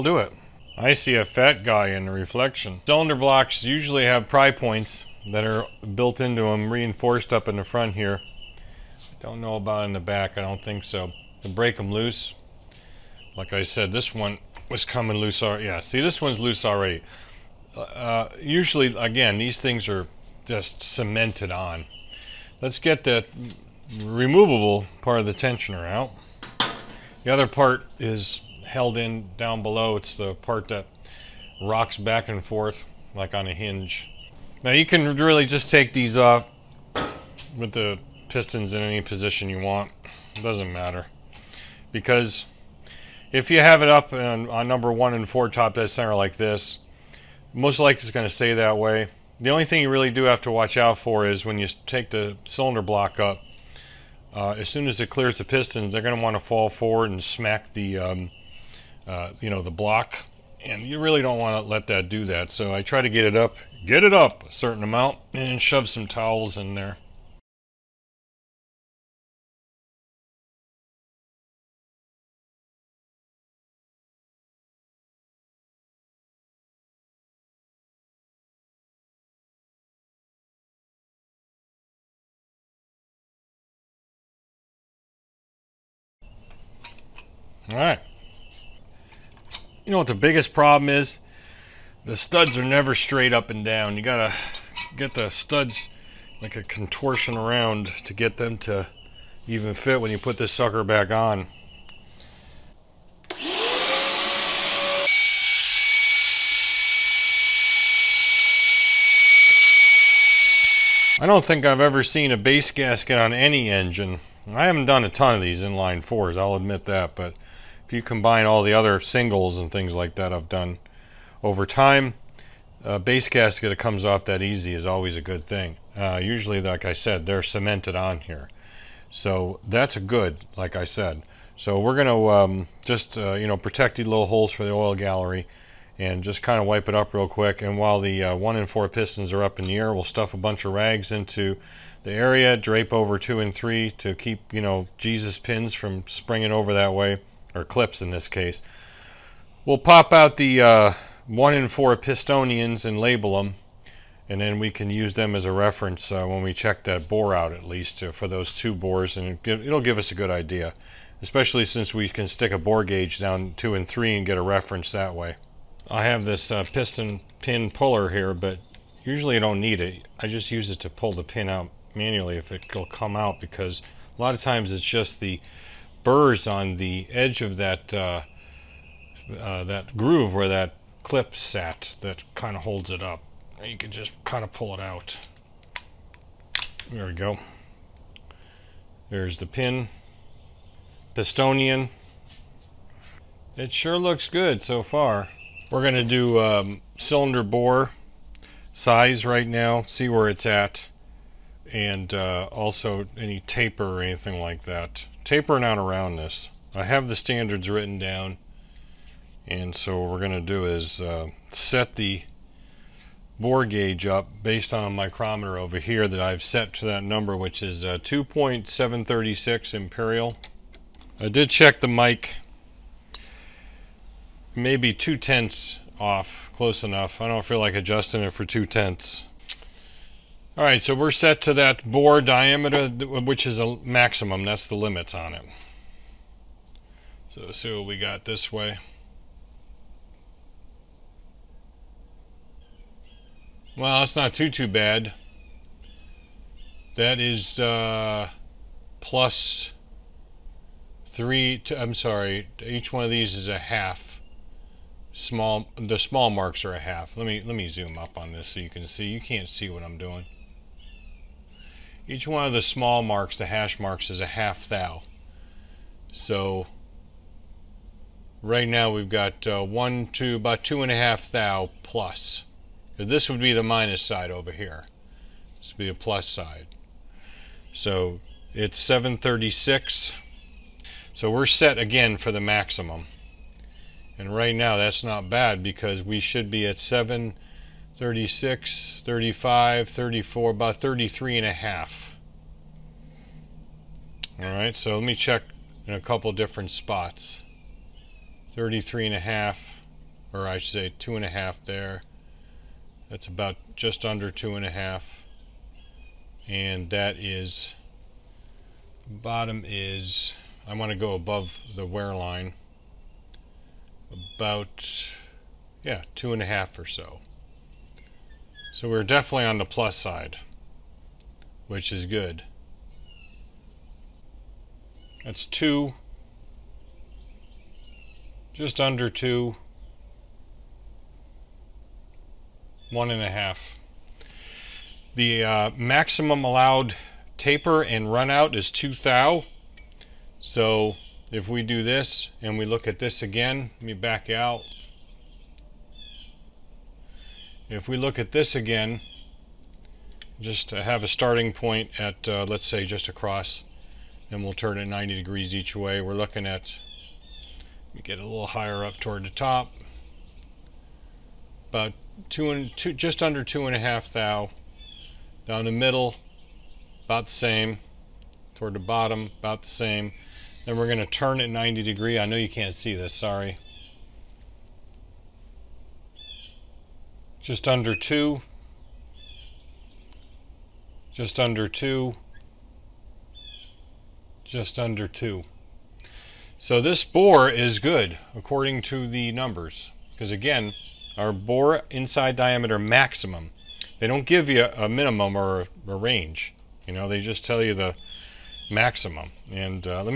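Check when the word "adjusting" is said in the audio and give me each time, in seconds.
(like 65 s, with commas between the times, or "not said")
227 s.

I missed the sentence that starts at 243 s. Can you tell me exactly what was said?
Well, that's not too, too bad.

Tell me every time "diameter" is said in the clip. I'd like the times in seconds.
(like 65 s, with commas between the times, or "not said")
232 s, 392 s.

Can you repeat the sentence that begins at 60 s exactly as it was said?
And you really don't want to let that do that.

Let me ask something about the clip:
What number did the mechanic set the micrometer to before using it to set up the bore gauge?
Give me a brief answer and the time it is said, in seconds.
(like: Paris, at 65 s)
2.736, at 217 s.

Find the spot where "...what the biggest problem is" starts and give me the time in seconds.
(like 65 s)
89 s.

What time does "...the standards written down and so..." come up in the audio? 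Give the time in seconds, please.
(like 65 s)
207 s.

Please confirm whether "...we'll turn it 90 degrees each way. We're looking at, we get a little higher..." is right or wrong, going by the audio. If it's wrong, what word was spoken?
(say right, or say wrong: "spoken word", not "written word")
right.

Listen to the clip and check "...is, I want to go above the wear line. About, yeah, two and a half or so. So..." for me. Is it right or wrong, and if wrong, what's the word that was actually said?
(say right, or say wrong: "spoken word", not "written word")
right.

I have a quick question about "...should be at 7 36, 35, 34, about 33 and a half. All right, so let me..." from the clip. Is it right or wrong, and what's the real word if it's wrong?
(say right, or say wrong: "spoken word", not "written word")
right.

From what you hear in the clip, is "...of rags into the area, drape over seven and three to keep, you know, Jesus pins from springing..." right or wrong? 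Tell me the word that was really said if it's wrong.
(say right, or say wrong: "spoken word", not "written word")
wrong: "two", not "seven".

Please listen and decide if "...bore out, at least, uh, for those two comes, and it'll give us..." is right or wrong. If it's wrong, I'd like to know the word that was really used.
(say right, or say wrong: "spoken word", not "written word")
wrong: "bores", not "comes".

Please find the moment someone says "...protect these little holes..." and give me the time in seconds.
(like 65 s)
133 s.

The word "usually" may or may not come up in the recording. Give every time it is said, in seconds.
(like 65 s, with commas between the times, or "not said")
3 s, 18 s, 126 s, 169 s.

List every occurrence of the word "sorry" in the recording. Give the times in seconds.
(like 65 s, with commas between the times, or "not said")
251 s, 373 s.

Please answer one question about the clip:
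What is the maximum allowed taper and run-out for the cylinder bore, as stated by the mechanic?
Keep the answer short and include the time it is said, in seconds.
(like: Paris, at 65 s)
Two thou, at 338 s.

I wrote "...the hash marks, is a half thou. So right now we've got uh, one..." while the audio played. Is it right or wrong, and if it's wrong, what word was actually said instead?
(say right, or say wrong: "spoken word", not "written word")
right.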